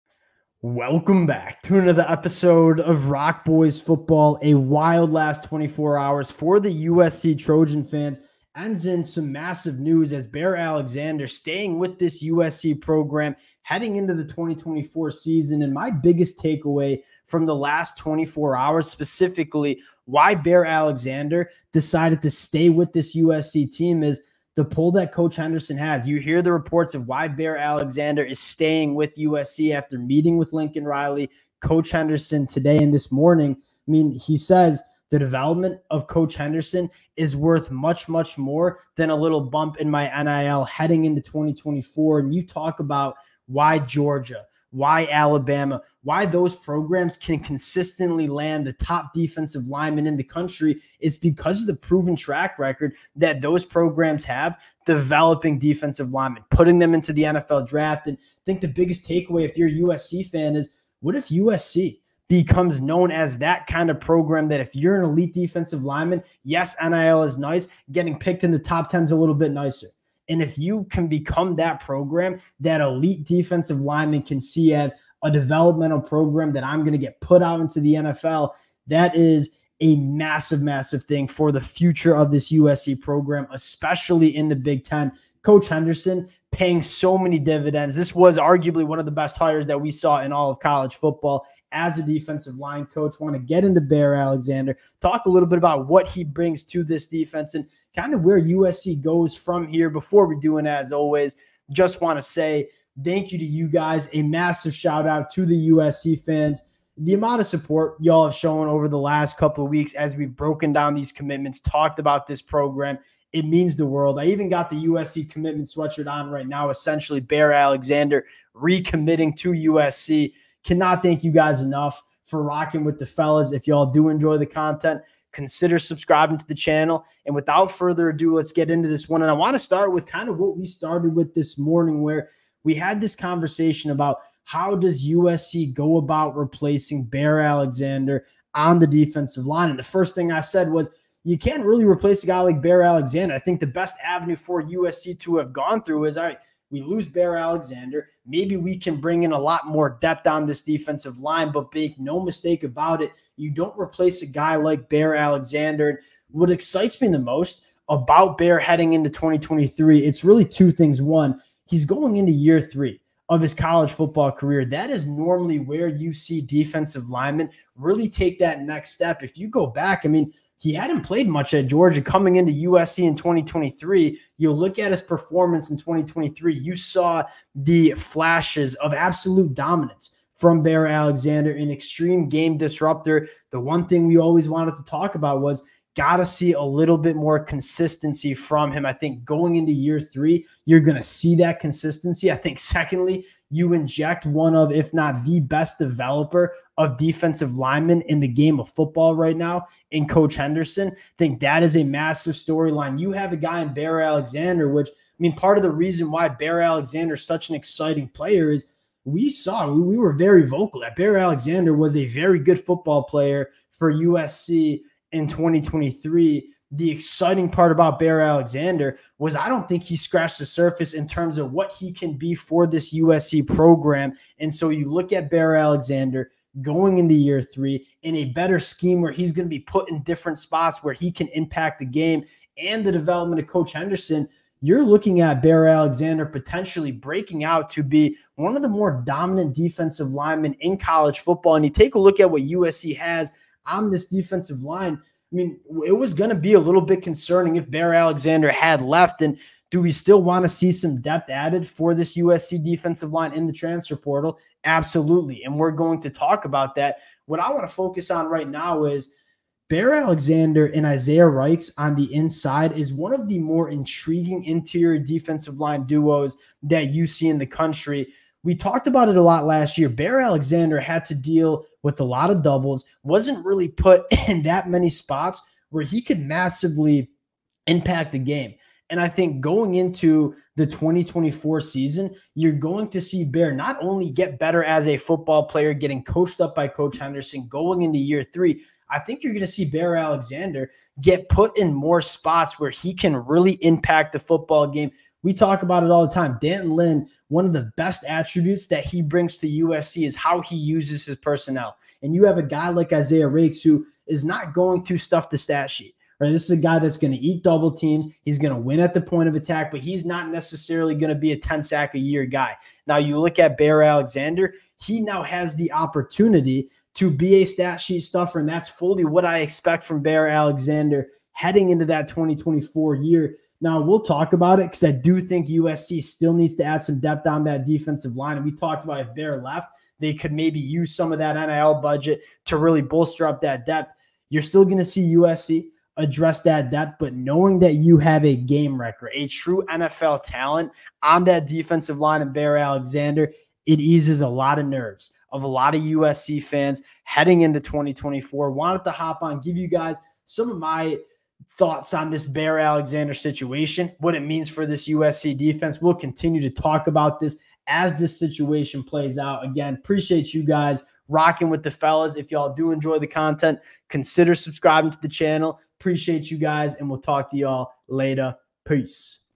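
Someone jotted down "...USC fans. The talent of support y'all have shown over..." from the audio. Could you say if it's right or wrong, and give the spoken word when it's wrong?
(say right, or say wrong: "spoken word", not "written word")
wrong: "amount", not "talent".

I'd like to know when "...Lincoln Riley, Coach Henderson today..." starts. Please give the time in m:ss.
0:30.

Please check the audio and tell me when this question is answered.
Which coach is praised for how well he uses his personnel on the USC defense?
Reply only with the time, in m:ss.
4:56.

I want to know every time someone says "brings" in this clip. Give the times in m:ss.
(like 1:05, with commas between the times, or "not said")
1:36, 2:28, 4:59.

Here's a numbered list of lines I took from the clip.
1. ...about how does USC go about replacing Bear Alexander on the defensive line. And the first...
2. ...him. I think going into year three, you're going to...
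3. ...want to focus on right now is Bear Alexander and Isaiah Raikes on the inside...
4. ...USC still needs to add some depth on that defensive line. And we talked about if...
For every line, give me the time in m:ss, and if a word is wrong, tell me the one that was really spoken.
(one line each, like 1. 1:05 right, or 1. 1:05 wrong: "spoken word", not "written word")
1. 2:13 right
2. 3:08 right
3. 4:17 right
4. 5:25 right.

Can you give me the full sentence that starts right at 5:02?
And you have a guy like Isaiah Raikes who is not going to stuff the stat sheet.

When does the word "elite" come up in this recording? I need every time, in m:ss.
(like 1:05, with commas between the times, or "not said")
1:05, 1:12.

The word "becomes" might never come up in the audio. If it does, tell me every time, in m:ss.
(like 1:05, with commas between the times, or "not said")
1:02, 1:11.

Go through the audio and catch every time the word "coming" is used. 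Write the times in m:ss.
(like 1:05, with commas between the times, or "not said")
2:52.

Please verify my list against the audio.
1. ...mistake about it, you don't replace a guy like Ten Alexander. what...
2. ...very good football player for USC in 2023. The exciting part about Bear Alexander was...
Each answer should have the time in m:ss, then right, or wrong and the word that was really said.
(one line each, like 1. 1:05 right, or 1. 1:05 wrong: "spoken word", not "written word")
1. 2:32 wrong: "Bear", not "Ten"
2. 3:32 right.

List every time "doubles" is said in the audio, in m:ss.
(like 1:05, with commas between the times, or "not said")
4:32, 5:07.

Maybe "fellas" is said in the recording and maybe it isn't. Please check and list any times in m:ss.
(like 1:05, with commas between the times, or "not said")
2:03, 6:01.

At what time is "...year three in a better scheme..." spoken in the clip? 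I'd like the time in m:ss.
3:47.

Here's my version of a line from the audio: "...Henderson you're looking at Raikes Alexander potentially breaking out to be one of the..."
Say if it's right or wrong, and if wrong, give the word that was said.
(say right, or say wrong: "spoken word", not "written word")
wrong: "Bear", not "Raikes".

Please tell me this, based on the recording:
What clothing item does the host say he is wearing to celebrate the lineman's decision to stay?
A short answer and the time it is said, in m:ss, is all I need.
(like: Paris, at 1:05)
USC commitment sweatshirt, at 1:54.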